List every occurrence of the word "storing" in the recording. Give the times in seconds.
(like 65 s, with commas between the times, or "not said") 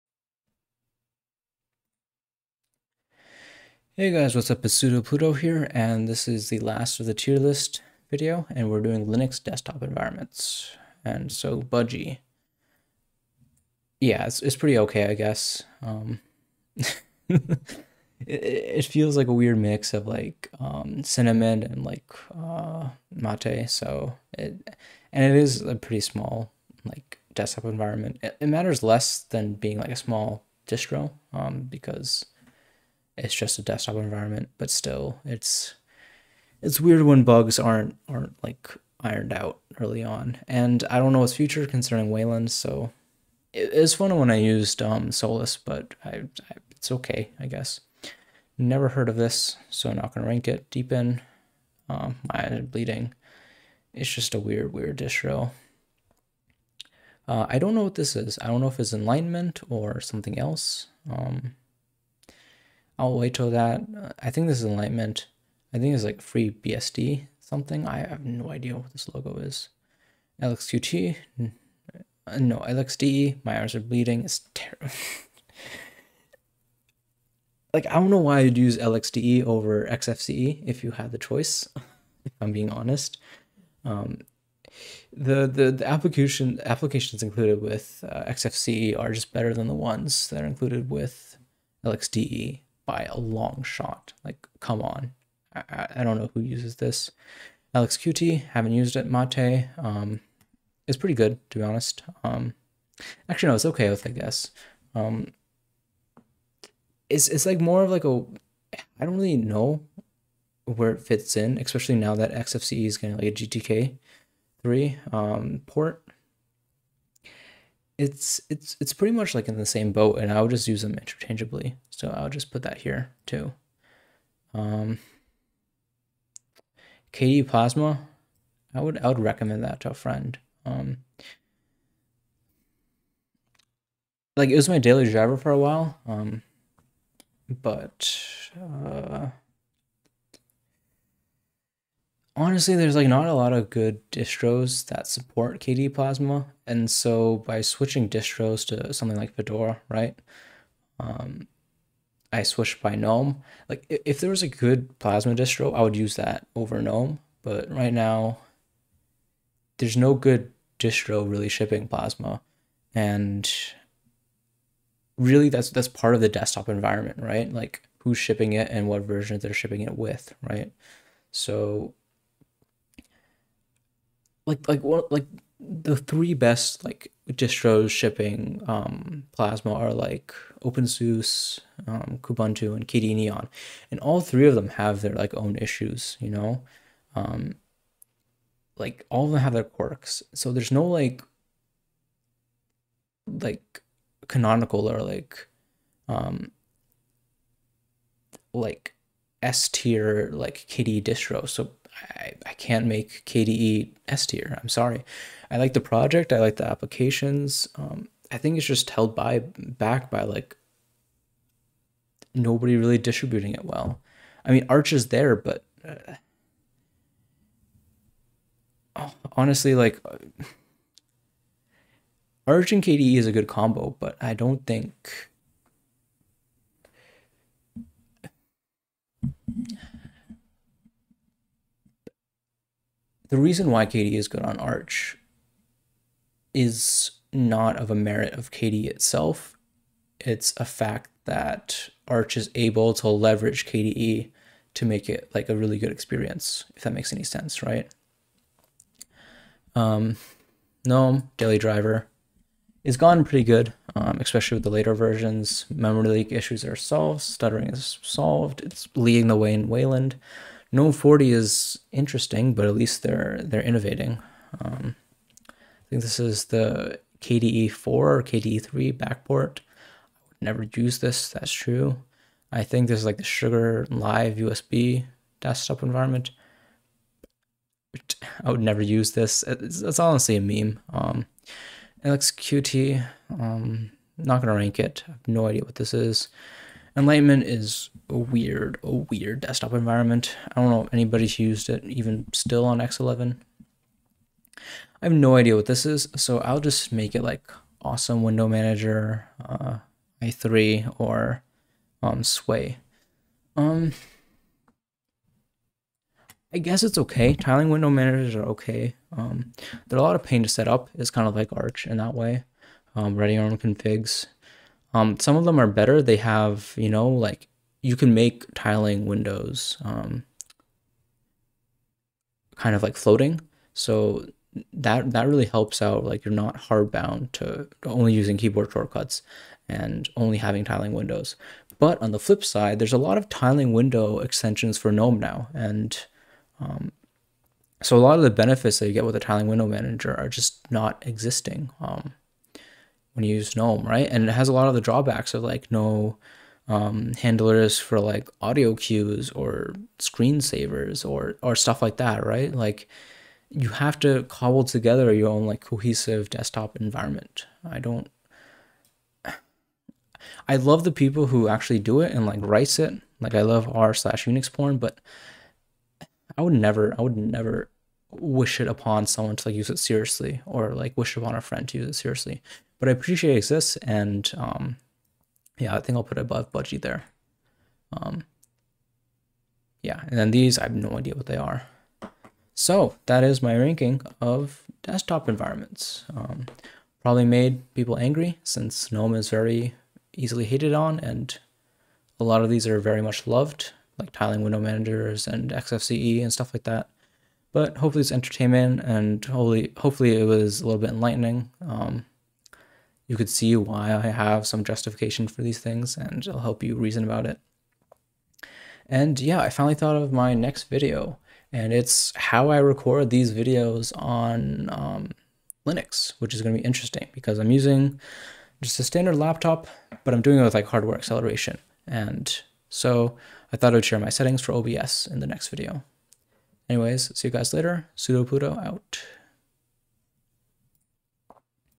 not said.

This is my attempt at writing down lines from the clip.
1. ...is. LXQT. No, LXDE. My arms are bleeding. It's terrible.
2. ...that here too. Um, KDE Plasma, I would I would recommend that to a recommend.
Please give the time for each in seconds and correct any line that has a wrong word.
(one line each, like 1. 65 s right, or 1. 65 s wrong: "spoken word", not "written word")
1. 69 s right
2. 122 s wrong: "friend", not "recommend".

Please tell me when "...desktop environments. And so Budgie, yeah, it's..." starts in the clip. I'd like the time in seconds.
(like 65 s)
9 s.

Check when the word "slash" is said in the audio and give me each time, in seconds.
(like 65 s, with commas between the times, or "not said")
363 s.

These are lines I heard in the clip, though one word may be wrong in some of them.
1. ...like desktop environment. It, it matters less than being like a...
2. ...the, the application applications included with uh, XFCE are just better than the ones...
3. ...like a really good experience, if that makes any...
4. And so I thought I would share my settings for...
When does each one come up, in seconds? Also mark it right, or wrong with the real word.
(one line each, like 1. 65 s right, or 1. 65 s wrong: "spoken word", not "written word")
1. 26 s right
2. 85 s right
3. 245 s right
4. 421 s right.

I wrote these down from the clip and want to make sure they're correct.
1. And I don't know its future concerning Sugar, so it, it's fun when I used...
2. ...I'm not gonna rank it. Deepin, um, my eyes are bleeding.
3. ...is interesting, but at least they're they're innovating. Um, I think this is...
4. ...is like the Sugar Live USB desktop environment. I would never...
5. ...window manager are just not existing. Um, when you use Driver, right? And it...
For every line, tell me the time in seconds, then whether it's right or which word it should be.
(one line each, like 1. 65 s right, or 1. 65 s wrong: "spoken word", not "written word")
1. 40 s wrong: "Wayland", not "Sugar"
2. 49 s right
3. 261 s right
4. 272 s right
5. 339 s wrong: "GNOME", not "Driver".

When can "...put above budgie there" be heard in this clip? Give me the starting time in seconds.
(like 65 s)
376 s.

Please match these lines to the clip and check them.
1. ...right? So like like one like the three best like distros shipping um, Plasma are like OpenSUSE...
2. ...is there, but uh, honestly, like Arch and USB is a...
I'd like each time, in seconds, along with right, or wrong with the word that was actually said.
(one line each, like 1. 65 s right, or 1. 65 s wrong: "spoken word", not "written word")
1. 170 s right
2. 214 s wrong: "KDE", not "USB".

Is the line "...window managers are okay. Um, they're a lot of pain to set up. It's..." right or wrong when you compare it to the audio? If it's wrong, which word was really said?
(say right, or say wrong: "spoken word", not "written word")
right.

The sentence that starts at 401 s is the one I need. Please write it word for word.
Um, you could see why I have some justification for these things and it'll help you reason about it.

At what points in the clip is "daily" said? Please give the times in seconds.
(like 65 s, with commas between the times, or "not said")
134 s, 251 s.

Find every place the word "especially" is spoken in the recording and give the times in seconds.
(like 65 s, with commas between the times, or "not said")
111 s, 254 s.